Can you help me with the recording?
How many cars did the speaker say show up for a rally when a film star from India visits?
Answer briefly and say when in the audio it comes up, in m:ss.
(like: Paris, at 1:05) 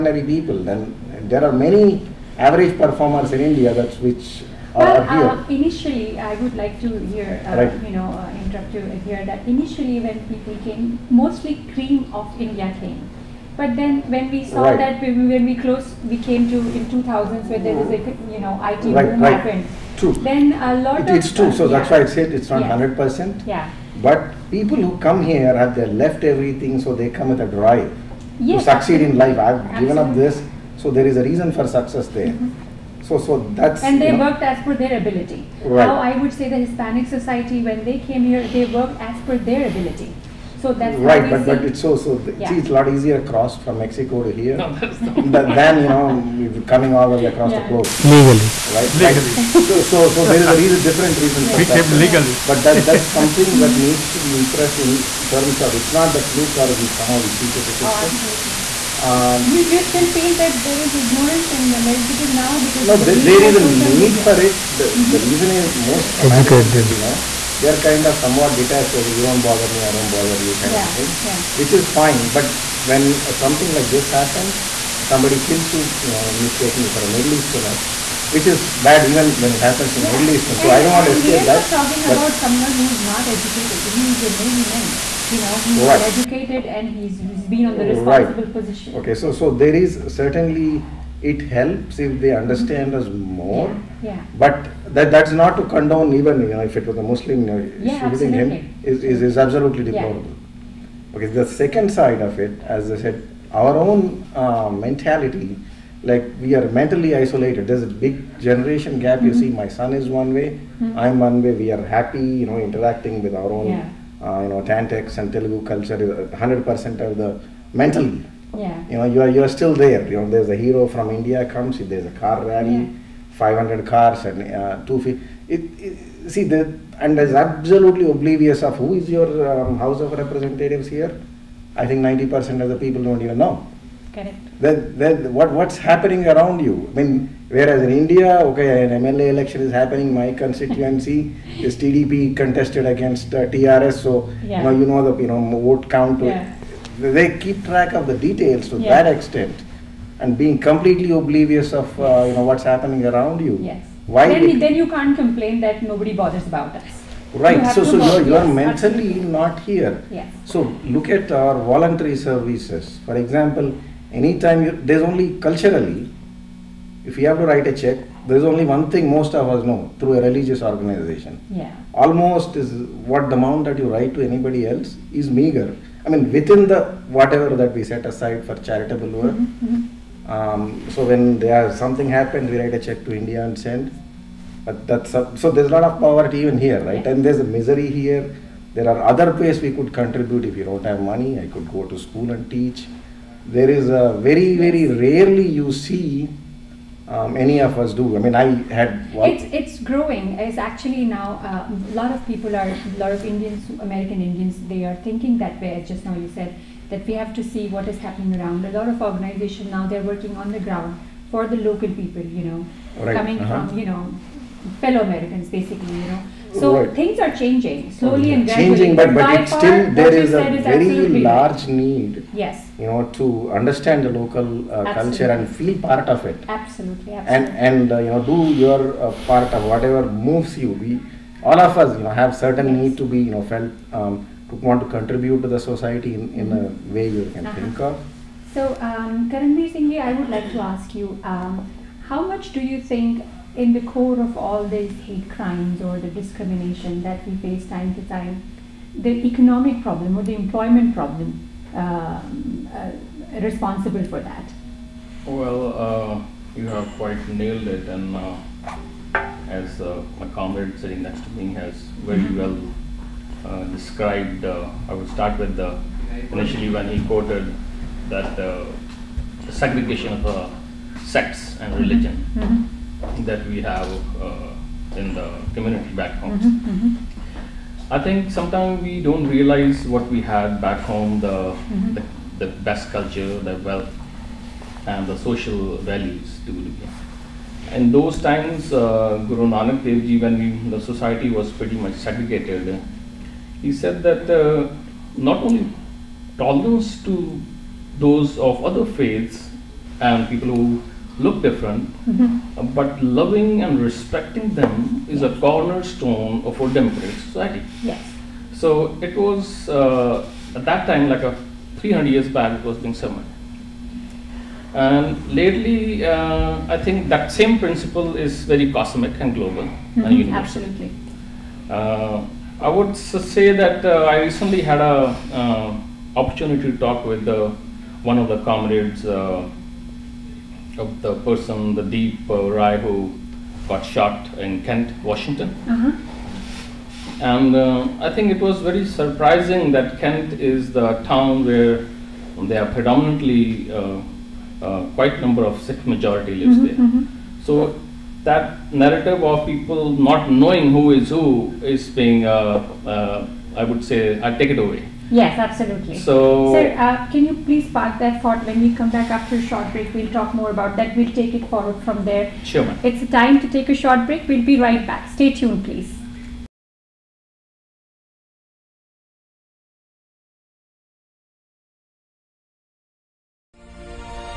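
500, at 2:03.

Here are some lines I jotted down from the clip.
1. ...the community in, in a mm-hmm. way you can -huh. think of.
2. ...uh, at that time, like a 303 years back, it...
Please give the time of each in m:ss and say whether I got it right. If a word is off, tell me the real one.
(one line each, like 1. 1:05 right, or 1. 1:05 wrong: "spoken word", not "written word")
1. 3:55 wrong: "society", not "community"
2. 5:09 wrong: "300", not "303".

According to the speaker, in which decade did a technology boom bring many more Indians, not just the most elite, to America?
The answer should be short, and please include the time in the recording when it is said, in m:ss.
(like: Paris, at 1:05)
2000s, at 0:16.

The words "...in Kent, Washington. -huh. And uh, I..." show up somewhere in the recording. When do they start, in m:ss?
5:34.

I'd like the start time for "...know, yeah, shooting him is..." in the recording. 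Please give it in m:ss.
1:37.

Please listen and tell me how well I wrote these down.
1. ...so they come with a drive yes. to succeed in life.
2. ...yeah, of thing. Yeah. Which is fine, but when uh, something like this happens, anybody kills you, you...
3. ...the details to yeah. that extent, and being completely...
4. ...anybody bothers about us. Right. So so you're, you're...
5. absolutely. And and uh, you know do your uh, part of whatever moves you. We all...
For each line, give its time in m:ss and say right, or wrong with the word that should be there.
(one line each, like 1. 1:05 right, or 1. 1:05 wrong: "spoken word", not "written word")
1. 0:26 right
2. 1:10 wrong: "somebody", not "anybody"
3. 2:28 right
4. 2:35 wrong: "nobody", not "anybody"
5. 3:47 right.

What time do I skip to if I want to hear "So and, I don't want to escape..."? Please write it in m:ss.
1:20.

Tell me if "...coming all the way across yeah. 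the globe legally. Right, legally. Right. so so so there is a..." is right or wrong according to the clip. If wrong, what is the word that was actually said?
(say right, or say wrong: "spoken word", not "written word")
right.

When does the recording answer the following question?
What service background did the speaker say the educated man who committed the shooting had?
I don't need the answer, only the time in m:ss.
1:24.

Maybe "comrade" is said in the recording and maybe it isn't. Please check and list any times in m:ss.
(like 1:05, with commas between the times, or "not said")
4:20, 5:28.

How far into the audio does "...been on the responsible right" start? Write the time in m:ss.
1:27.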